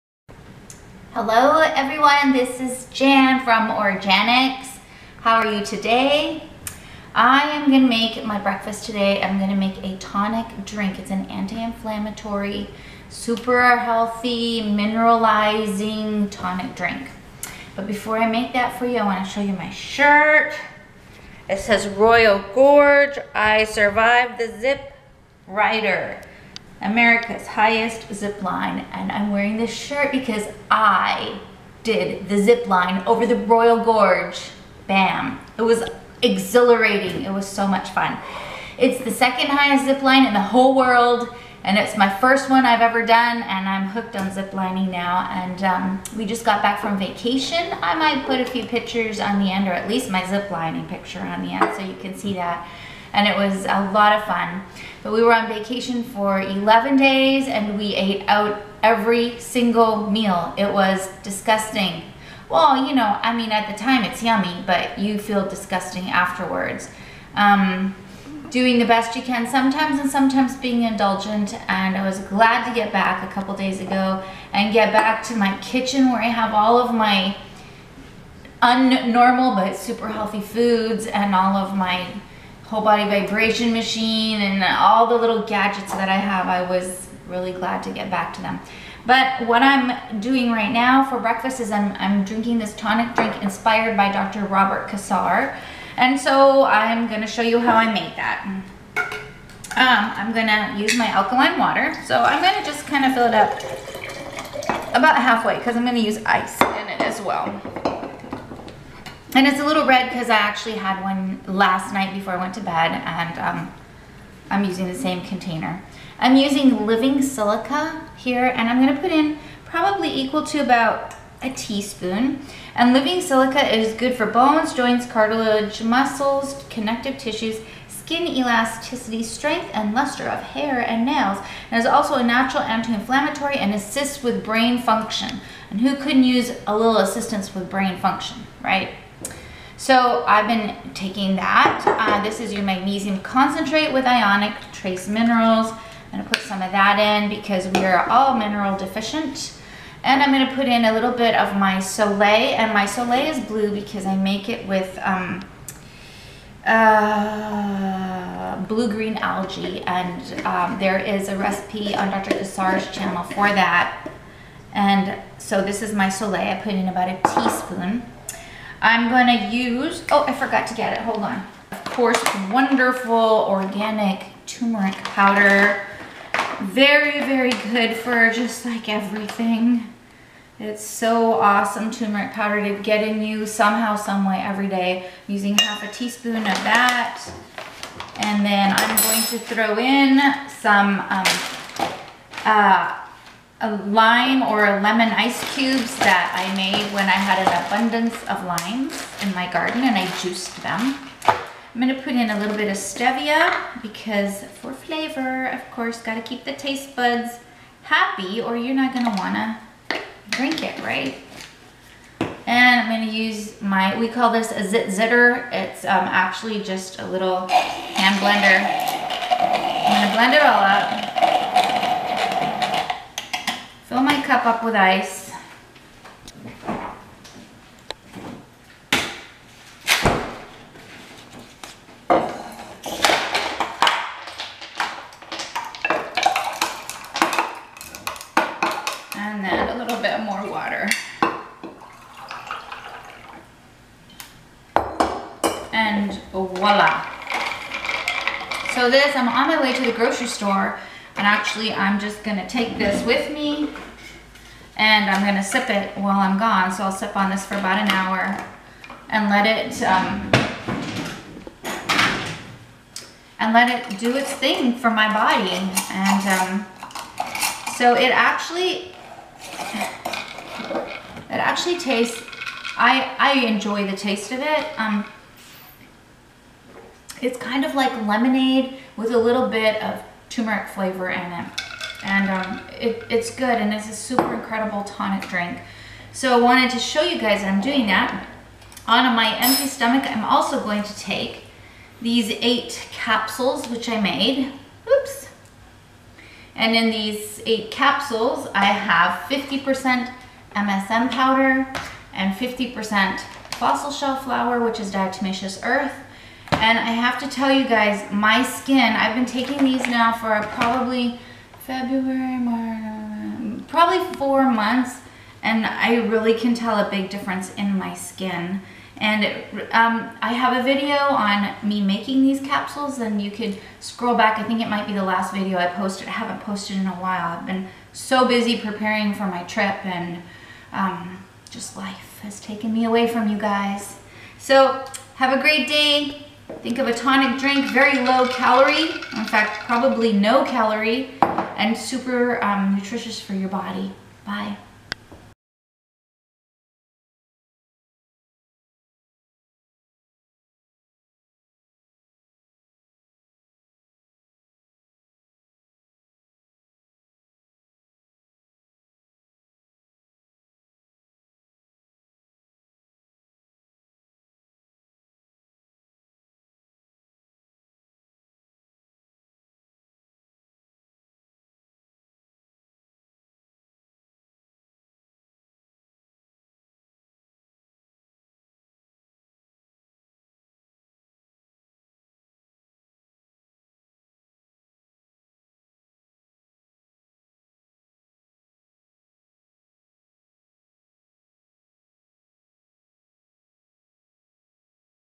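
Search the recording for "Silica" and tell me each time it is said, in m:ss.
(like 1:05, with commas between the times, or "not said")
1:57, 2:03.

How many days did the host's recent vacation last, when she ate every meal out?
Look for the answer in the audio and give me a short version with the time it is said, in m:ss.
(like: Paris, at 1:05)
11, at 0:56.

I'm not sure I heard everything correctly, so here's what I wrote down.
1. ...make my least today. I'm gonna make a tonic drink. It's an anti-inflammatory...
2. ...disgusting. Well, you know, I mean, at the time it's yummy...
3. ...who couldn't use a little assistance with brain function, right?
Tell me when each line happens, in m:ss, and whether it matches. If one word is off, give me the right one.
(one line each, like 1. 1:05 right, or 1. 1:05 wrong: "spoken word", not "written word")
1. 0:07 wrong: "breakfast", not "least"
2. 1:01 right
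3. 2:15 right.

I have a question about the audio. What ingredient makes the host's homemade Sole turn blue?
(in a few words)
blue-green algae.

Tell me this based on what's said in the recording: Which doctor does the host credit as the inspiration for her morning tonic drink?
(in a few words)
Dr. Robert Cassar.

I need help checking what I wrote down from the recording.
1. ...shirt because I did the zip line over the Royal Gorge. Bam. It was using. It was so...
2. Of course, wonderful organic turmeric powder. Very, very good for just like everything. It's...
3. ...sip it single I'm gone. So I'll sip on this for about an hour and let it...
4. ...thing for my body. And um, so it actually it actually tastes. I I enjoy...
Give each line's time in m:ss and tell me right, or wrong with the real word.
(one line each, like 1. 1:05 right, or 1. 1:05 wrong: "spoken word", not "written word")
1. 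0:29 wrong: "exhilarating", not "using"
2. 2:51 right
3. 4:15 wrong: "while", not "single"
4. 4:24 right.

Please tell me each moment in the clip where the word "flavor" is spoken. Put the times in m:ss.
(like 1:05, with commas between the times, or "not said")
3:24, 4:40.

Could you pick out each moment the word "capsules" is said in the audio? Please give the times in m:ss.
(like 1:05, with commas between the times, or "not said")
4:52, 4:57, 5:22.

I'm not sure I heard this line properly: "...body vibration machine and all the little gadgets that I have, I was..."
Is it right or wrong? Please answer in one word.
right.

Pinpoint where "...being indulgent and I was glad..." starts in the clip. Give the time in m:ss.
1:10.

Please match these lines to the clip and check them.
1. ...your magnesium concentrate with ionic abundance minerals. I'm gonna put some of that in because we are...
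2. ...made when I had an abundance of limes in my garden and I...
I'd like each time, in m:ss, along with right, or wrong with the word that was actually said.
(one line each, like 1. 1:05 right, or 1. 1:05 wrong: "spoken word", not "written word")
1. 2:22 wrong: "trace", not "abundance"
2. 3:16 right.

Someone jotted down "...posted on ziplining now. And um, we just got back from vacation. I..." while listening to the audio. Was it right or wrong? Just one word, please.
wrong.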